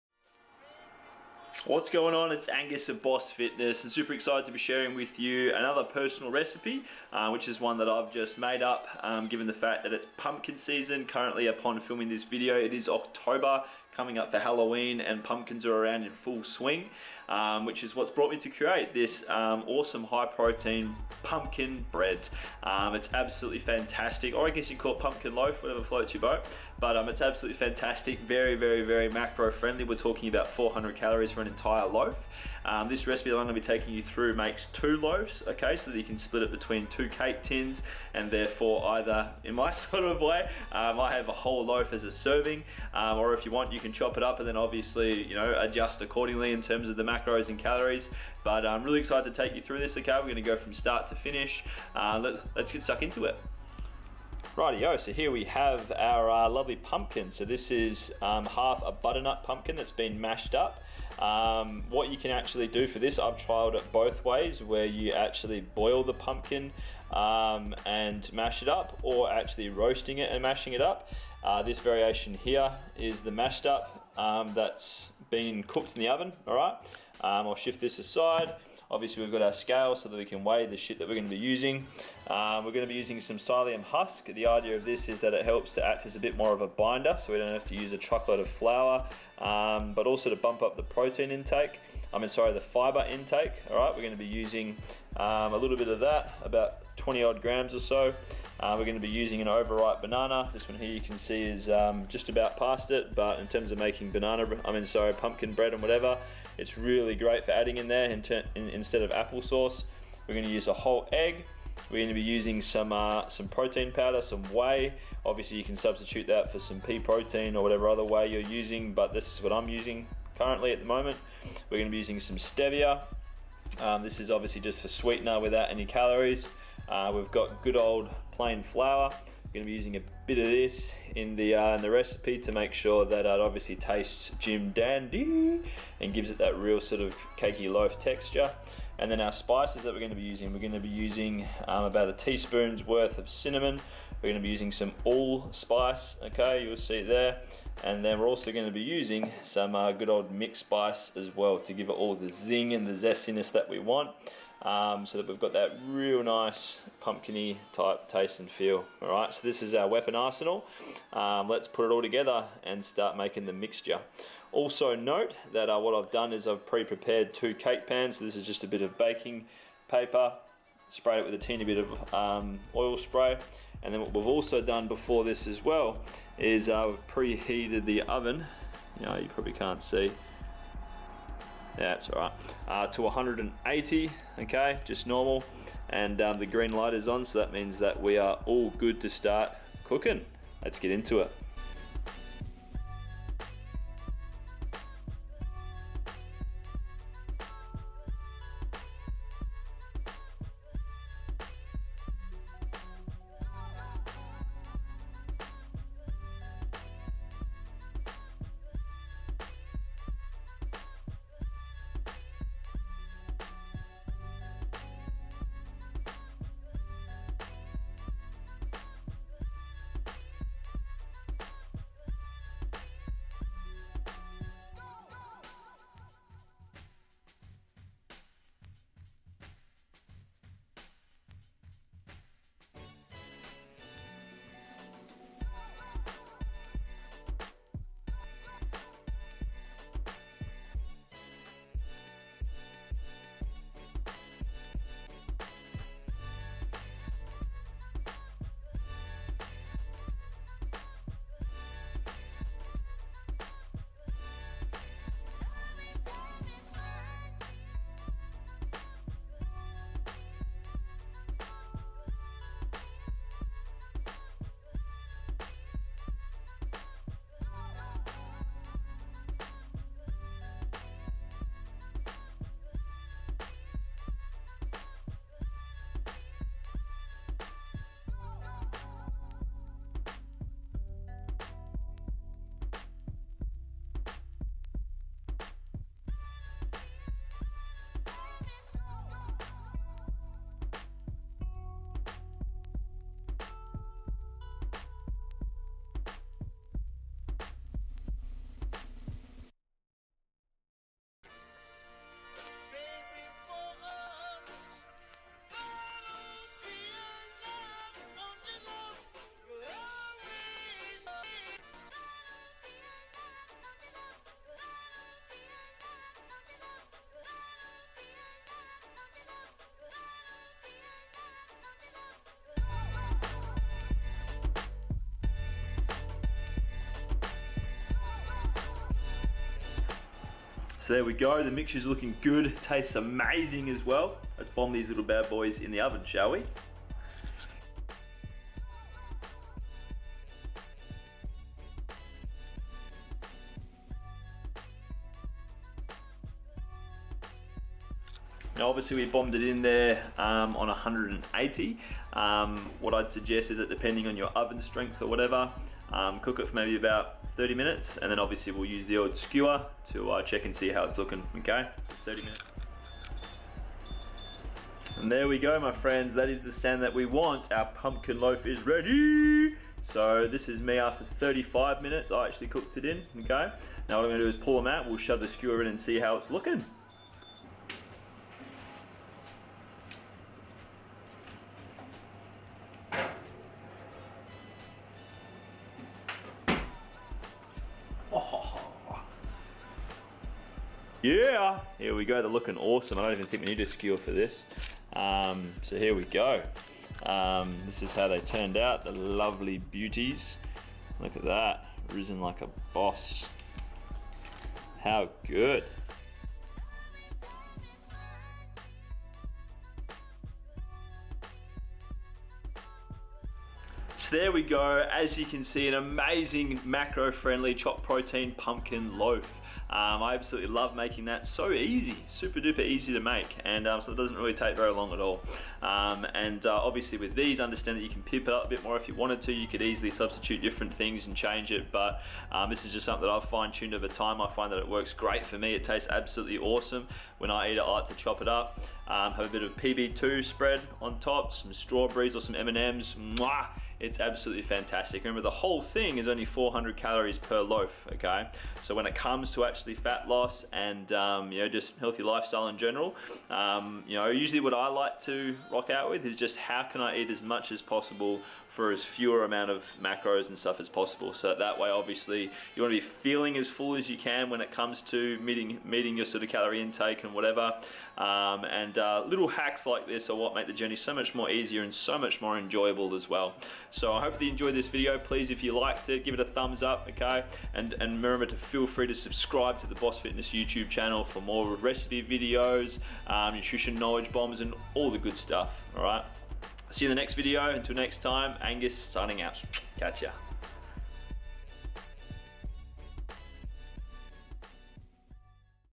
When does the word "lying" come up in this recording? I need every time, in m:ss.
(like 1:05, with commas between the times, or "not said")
not said.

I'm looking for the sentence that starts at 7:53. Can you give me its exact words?
So I hope that you enjoyed this video.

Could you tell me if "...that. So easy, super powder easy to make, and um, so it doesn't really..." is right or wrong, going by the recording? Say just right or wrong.
wrong.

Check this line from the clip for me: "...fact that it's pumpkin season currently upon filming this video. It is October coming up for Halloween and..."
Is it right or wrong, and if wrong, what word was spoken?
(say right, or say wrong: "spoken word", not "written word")
right.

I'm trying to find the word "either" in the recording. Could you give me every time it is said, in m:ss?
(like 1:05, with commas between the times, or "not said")
0:38.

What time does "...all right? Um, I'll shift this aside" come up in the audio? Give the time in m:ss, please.
1:16.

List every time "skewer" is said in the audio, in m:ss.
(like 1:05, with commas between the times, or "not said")
5:59, 6:15, 6:33.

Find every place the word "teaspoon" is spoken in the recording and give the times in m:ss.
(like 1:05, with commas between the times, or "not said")
2:22.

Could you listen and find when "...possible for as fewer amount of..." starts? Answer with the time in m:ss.
7:37.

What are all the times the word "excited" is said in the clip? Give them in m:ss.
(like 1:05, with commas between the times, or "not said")
0:04, 0:49.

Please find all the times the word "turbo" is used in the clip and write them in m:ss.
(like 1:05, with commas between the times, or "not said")
not said.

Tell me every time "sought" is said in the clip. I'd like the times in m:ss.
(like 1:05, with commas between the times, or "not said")
not said.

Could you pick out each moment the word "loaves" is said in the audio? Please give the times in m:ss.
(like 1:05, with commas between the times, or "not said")
0:34.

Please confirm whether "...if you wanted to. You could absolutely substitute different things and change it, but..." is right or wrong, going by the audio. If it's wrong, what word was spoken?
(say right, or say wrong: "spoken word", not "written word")
wrong: "easily", not "absolutely".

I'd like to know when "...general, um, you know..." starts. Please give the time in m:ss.
7:32.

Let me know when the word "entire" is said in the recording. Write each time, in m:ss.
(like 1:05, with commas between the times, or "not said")
0:31.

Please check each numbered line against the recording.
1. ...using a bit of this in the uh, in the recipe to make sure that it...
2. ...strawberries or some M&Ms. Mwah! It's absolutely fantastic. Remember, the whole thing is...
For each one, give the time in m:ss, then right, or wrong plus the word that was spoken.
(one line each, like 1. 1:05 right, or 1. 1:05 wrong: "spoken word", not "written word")
1. 2:09 right
2. 7:21 right.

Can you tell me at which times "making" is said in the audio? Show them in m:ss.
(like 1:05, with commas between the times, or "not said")
1:43, 2:43, 7:00.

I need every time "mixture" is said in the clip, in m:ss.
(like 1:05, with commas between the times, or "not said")
2:43, 5:31.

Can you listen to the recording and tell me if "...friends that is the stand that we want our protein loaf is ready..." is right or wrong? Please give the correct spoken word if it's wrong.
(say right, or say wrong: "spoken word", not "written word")
wrong: "pumpkin", not "protein".